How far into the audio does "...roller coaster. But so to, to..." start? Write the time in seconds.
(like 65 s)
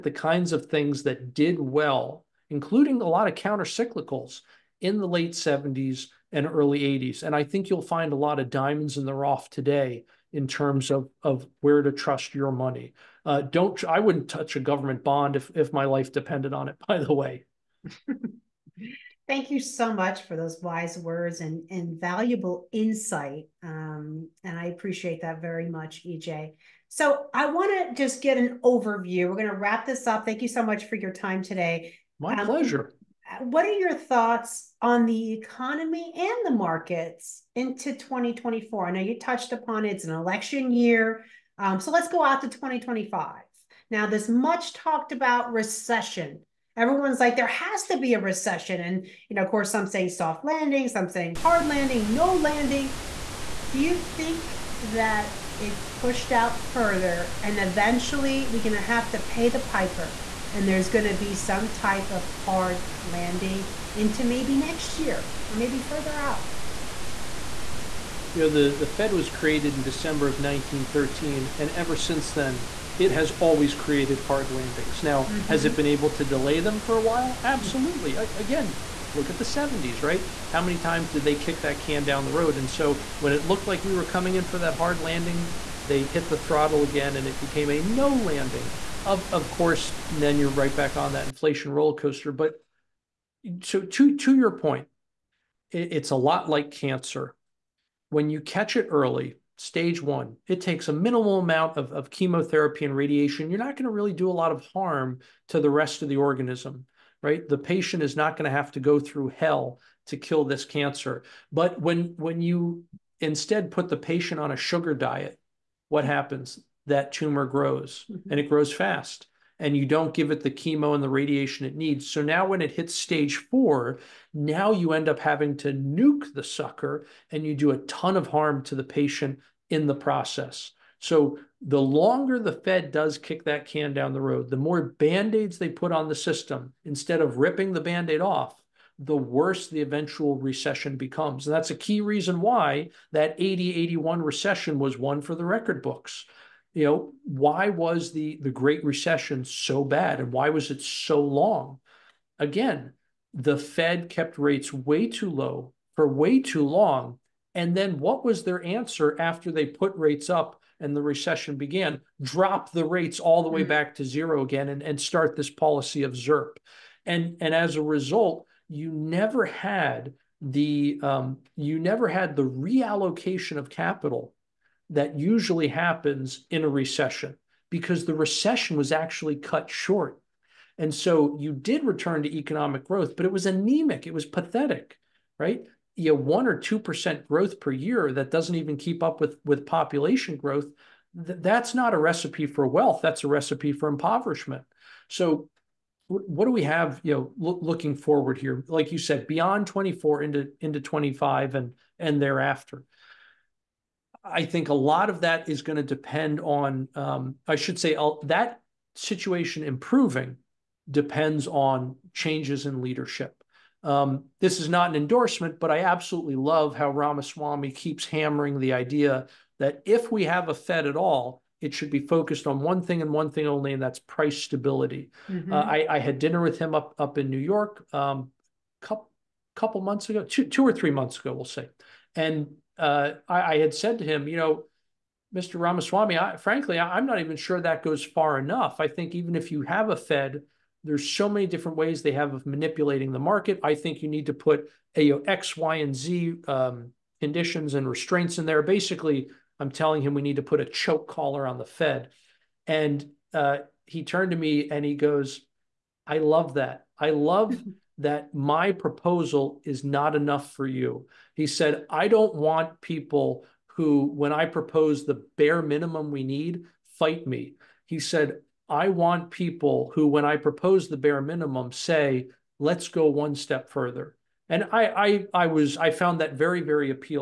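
91 s.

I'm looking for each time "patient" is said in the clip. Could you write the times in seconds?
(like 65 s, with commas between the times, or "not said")
107 s, 113 s, 128 s.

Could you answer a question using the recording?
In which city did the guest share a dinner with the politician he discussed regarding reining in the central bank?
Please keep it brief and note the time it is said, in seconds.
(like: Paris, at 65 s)
New York, at 227 s.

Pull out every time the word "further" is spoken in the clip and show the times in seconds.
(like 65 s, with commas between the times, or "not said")
56 s, 65 s, 273 s.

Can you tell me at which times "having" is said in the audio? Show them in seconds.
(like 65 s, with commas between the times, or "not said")
125 s.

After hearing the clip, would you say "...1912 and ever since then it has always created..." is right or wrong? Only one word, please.
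wrong.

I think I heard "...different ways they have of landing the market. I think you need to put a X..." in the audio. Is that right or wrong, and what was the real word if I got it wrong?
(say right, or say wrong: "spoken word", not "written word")
wrong: "manipulating", not "landing".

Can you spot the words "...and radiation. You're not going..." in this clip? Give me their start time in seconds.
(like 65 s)
102 s.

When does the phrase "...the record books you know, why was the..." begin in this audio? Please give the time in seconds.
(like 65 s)
145 s.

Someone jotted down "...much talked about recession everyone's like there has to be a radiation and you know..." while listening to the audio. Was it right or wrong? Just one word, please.
wrong.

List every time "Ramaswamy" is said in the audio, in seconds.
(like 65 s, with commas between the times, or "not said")
216 s, 235 s.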